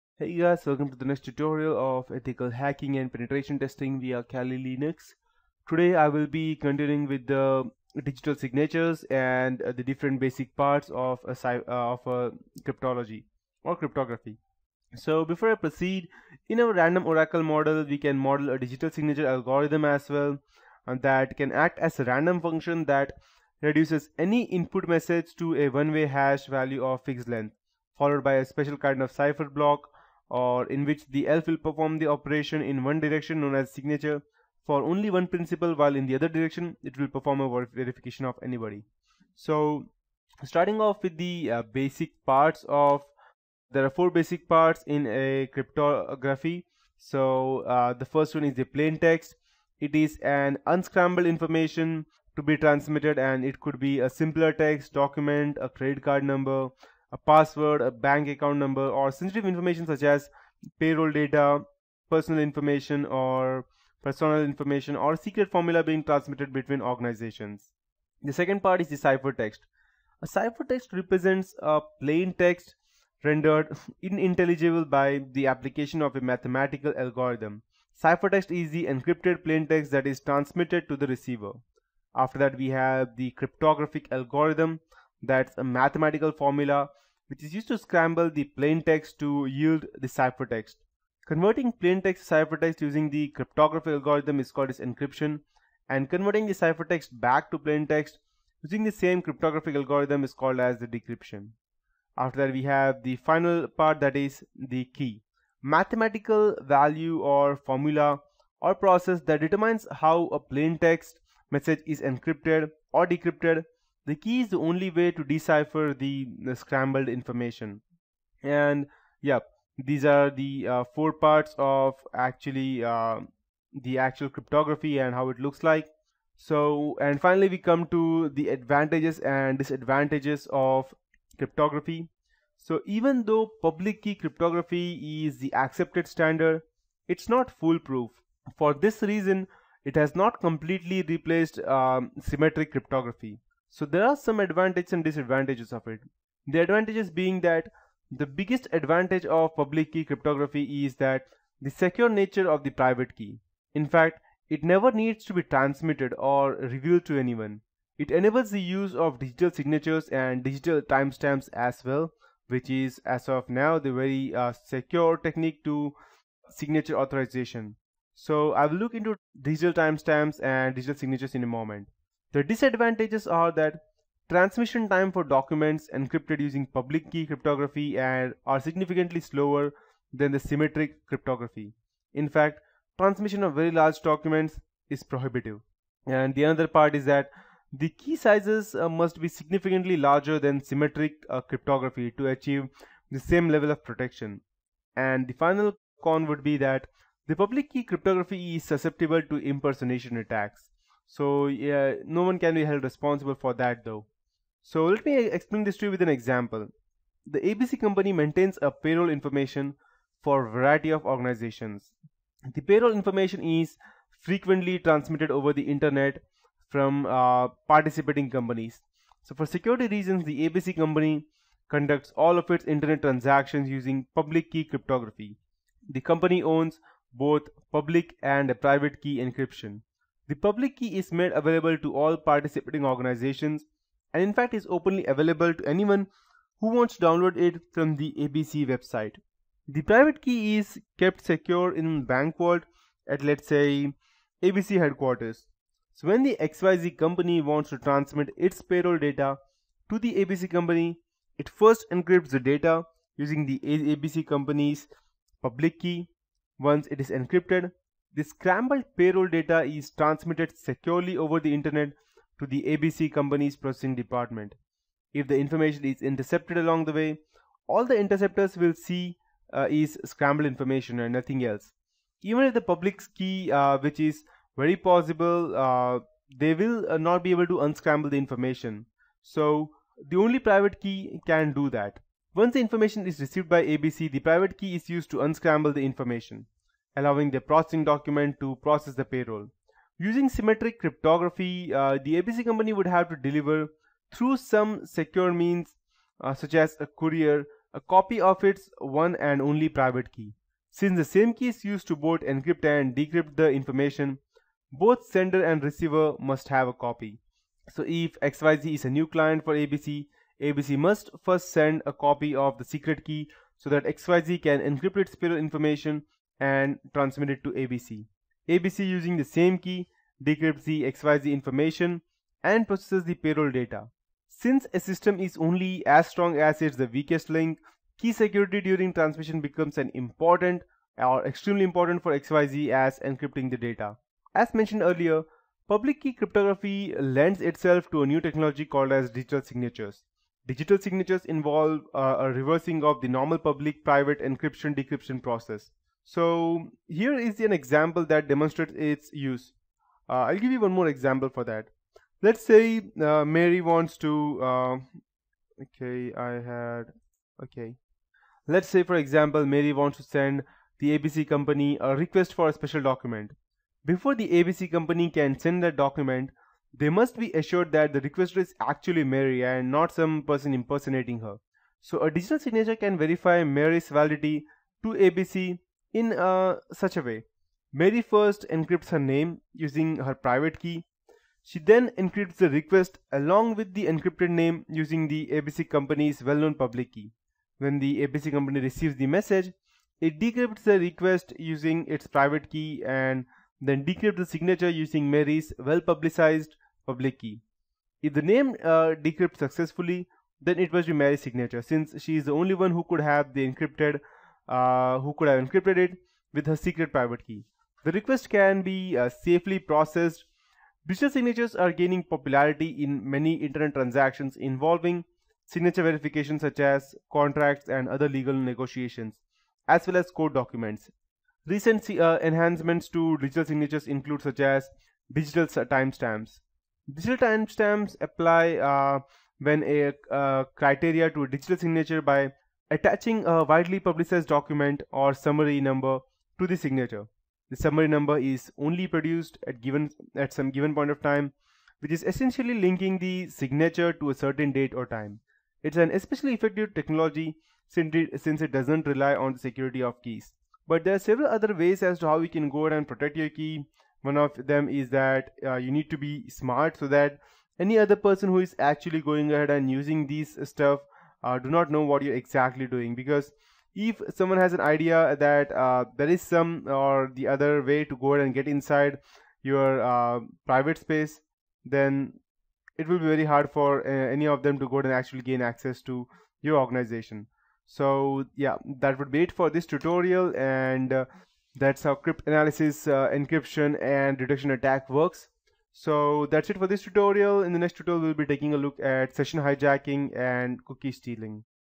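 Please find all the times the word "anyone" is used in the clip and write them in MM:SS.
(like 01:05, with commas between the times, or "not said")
02:37, 03:55.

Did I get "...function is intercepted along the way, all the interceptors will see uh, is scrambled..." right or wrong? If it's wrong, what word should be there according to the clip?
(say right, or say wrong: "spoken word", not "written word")
wrong: "information", not "function".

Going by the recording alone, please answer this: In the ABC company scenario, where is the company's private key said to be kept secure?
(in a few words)
bank vault.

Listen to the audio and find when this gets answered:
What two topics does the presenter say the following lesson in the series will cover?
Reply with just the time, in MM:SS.
08:09.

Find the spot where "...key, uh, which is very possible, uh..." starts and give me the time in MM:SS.
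04:33.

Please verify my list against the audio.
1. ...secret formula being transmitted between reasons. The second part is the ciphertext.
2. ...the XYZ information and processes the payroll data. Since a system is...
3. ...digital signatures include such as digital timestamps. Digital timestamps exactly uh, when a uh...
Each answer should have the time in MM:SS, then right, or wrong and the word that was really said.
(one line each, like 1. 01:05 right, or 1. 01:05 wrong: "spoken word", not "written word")
1. 01:05 wrong: "organizations", not "reasons"
2. 05:20 right
3. 07:03 wrong: "apply", not "exactly".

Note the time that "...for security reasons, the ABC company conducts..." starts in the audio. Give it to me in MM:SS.
03:39.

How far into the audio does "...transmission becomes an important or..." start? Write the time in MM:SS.
05:28.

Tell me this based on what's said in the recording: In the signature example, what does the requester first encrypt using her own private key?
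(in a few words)
her name.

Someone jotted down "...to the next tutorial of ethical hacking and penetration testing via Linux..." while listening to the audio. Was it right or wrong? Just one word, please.
wrong.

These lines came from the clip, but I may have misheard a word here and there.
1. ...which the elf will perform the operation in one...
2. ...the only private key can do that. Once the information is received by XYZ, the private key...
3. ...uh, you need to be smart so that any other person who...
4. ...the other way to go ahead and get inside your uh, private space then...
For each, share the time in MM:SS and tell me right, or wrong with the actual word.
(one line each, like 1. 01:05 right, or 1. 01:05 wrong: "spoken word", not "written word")
1. 00:30 right
2. 04:40 wrong: "ABC", not "XYZ"
3. 07:35 right
4. 07:47 right.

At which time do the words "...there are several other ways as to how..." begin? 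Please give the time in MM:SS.
07:30.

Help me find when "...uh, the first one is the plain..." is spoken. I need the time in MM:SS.
00:47.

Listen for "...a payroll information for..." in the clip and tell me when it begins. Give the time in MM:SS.
03:28.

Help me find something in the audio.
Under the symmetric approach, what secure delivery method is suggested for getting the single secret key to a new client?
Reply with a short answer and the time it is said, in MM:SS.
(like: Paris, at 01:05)
a courier, at 04:56.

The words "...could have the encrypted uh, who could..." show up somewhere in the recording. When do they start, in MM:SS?
06:42.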